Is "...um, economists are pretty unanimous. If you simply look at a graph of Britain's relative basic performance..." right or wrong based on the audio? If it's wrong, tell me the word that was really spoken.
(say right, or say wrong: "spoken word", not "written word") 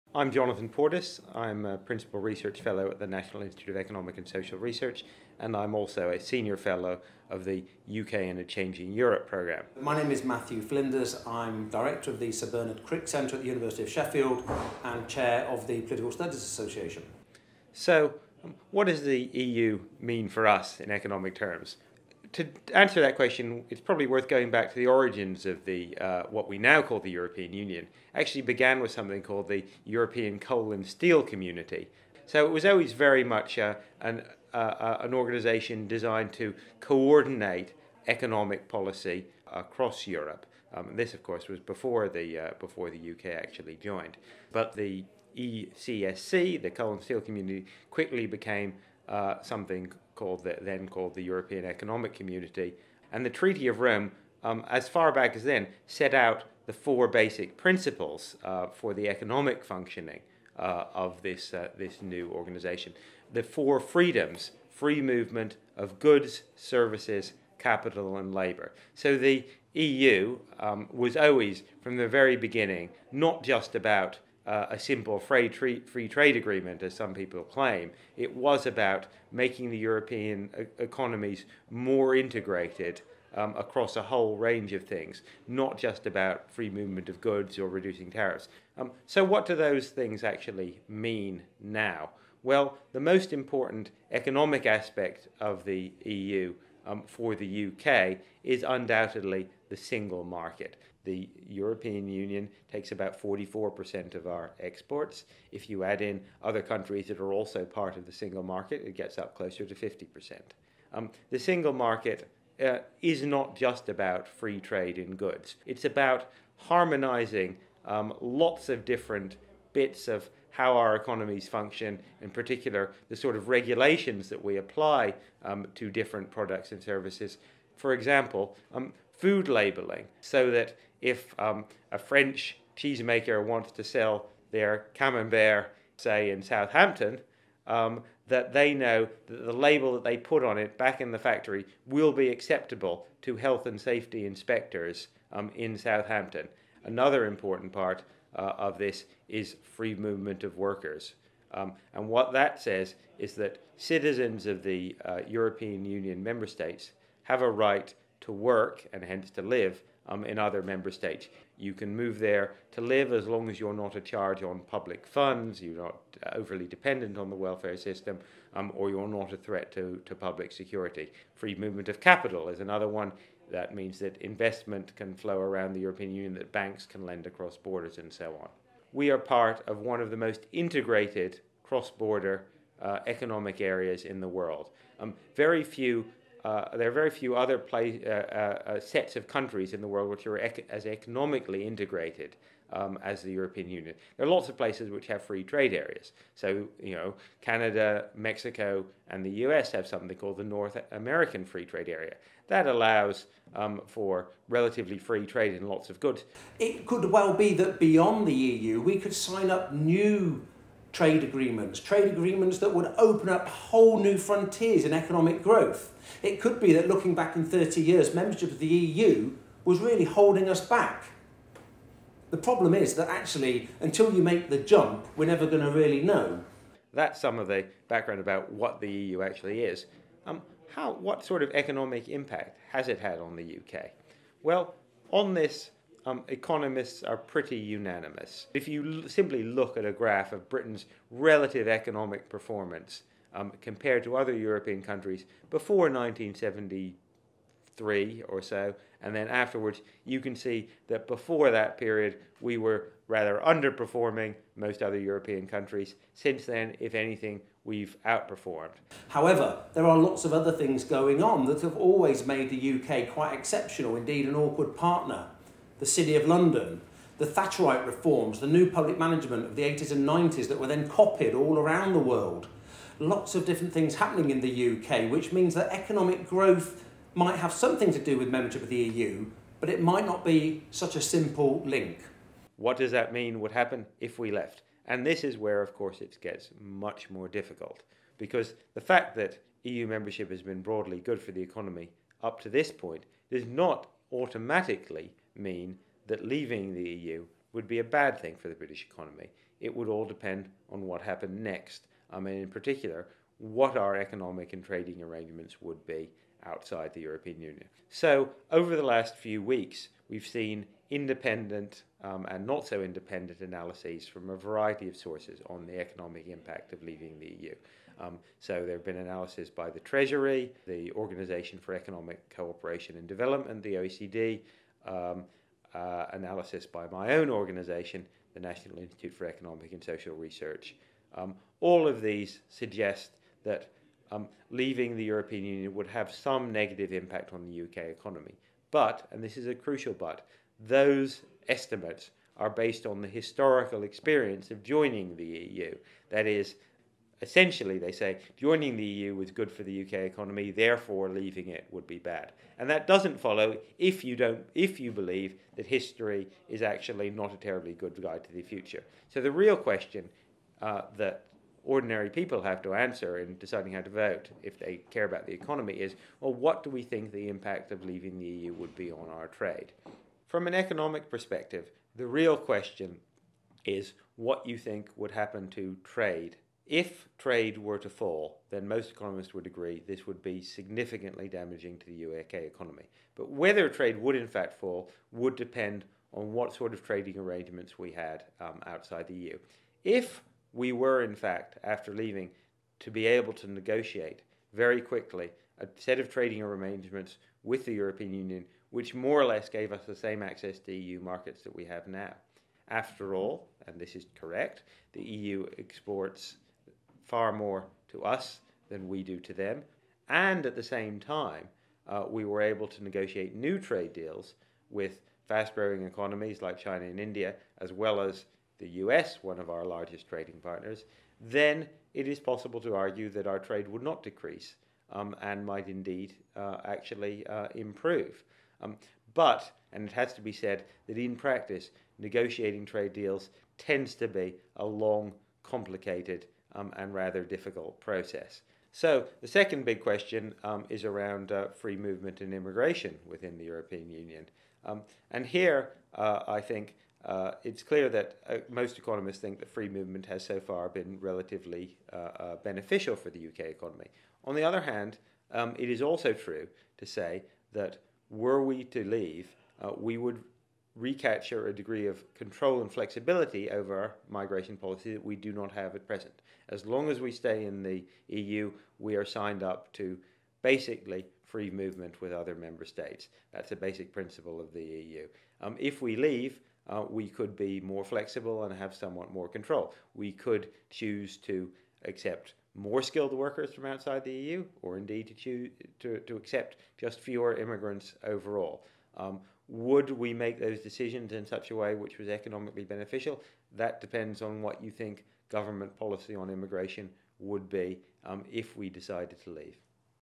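wrong: "economic", not "basic".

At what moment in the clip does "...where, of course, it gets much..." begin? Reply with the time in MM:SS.
04:45.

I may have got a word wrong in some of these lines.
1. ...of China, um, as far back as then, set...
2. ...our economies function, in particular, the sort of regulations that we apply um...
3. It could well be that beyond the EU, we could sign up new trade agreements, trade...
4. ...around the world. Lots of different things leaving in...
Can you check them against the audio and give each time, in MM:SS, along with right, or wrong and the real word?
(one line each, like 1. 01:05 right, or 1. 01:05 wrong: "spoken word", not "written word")
1. 00:53 wrong: "Rome", not "China"
2. 02:00 right
3. 03:26 right
4. 04:31 wrong: "happening", not "leaving".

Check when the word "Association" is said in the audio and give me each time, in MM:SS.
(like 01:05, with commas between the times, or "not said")
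00:16.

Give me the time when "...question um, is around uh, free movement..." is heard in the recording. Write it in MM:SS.
07:19.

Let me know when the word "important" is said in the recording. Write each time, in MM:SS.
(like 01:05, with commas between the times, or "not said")
01:33, 02:27.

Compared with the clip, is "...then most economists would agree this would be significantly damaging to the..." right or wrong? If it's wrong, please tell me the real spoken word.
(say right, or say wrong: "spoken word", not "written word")
right.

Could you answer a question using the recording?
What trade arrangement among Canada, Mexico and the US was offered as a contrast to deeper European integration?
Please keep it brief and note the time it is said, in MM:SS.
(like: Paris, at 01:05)
North American Free Trade Area, at 03:20.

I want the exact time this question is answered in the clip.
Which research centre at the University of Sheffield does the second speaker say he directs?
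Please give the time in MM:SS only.
00:12.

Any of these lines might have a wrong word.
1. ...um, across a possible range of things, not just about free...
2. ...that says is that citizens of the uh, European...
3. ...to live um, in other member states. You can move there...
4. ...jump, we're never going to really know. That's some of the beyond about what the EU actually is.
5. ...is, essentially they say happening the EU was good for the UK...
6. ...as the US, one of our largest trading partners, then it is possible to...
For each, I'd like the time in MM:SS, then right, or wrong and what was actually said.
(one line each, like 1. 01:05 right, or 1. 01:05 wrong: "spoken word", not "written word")
1. 01:23 wrong: "whole", not "possible"
2. 02:32 right
3. 02:39 right
4. 03:44 wrong: "background", not "beyond"
5. 05:46 wrong: "joining", not "happening"
6. 06:57 right.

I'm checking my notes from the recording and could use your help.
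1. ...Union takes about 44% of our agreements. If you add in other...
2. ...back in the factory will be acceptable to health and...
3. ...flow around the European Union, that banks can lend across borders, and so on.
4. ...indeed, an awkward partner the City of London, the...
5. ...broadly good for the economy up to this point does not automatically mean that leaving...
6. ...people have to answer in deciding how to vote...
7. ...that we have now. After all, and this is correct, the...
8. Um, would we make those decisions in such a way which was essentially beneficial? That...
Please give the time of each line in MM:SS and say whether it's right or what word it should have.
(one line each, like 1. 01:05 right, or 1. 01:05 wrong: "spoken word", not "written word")
1. 01:42 wrong: "exports", not "agreements"
2. 02:20 right
3. 02:55 right
4. 04:23 right
5. 04:50 right
6. 06:02 right
7. 06:41 right
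8. 08:08 wrong: "economically", not "essentially".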